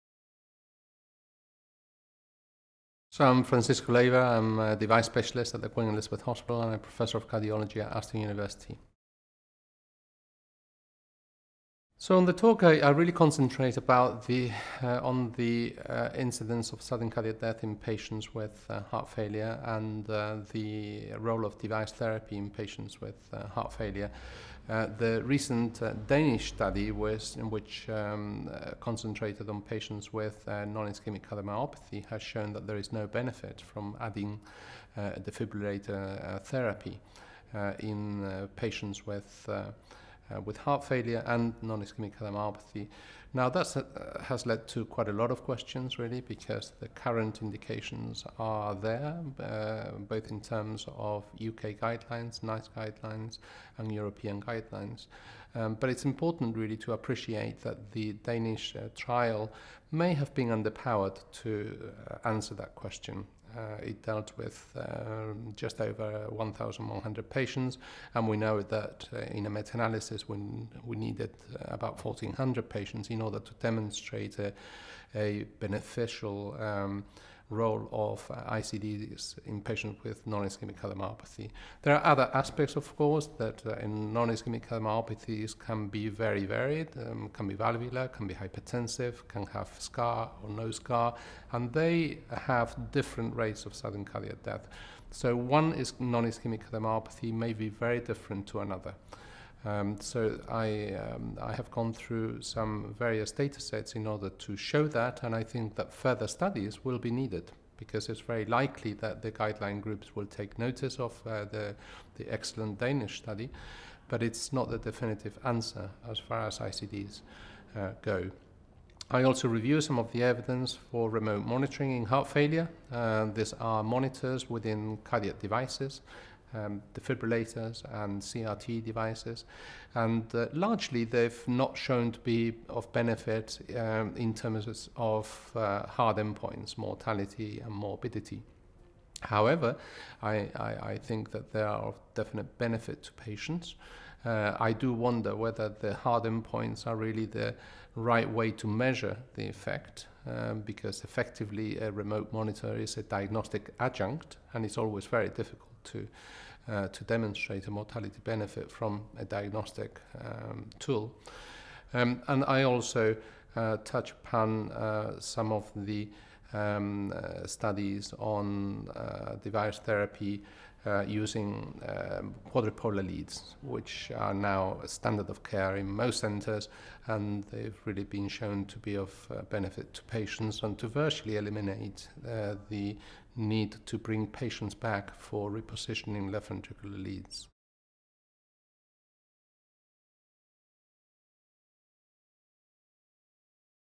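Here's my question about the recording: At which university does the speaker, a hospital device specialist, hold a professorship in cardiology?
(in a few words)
Aston University.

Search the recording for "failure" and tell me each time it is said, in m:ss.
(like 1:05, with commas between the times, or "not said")
0:19, 0:23, 0:40, 2:02.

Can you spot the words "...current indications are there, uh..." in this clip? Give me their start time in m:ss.
0:46.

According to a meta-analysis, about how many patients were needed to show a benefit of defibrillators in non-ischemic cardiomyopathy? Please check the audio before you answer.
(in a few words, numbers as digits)
1,400.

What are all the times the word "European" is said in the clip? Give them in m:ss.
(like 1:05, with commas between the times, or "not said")
0:53.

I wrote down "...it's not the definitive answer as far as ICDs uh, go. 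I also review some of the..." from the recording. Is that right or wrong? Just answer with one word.
right.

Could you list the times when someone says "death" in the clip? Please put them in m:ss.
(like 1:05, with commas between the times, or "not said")
0:17, 1:34.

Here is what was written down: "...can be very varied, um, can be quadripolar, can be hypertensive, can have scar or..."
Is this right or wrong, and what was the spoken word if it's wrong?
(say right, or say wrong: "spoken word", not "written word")
wrong: "valvular", not "quadripolar".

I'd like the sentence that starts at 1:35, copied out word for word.
So one is non-ischemic cardiomyopathy may be very different to another.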